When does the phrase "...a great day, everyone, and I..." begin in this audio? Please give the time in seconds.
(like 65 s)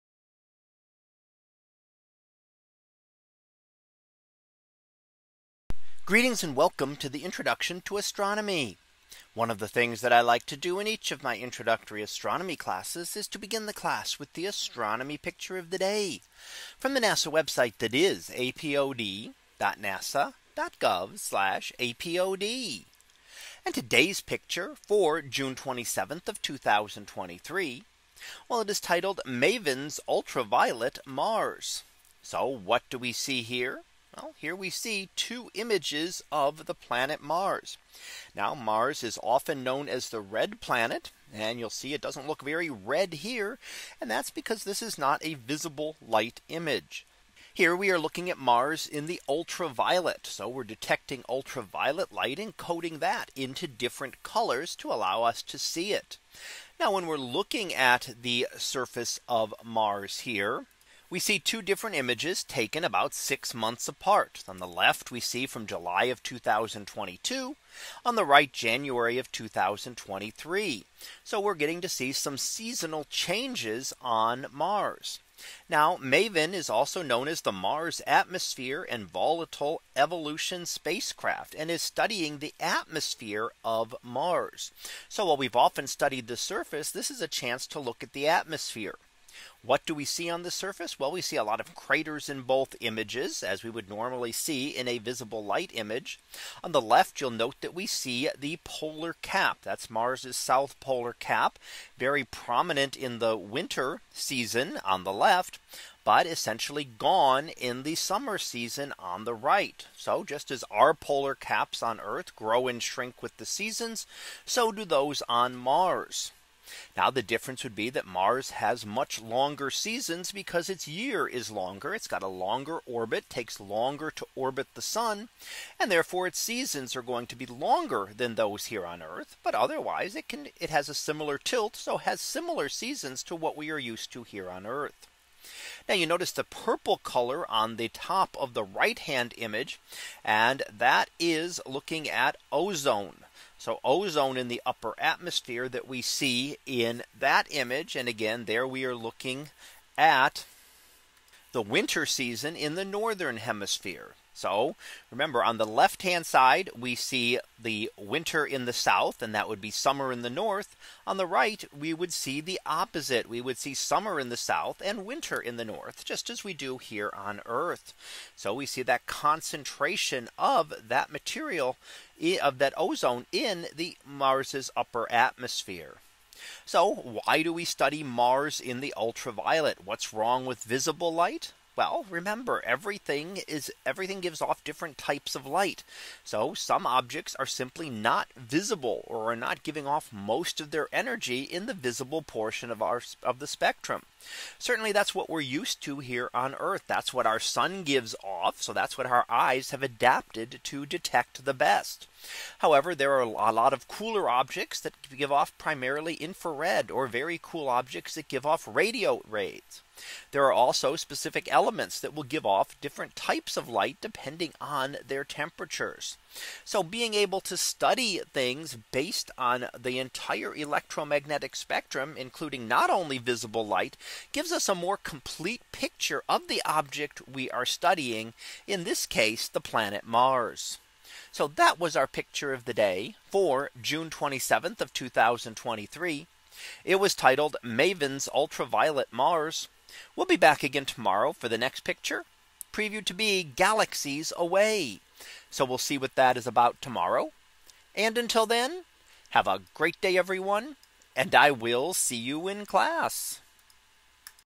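249 s.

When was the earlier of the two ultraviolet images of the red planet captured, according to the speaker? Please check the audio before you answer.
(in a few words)
July 2022.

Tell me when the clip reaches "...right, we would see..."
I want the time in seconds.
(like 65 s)
161 s.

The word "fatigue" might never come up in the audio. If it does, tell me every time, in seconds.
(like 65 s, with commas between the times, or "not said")
not said.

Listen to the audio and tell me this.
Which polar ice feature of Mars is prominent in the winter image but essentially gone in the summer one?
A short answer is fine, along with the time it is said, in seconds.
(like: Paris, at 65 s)
South polar cap, at 100 s.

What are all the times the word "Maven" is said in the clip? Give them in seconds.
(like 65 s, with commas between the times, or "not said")
29 s, 75 s, 237 s.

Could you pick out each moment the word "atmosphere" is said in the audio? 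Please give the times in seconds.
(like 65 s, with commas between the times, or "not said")
78 s, 82 s, 88 s, 144 s, 175 s.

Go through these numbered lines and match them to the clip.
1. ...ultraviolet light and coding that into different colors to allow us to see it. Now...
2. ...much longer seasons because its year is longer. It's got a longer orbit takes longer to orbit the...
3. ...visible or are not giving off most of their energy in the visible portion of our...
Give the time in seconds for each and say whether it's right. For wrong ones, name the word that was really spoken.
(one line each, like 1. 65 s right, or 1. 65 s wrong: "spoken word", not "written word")
1. 51 s right
2. 118 s right
3. 188 s right.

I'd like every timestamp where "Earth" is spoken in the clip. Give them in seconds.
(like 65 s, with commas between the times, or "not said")
112 s, 129 s, 134 s, 167 s, 196 s.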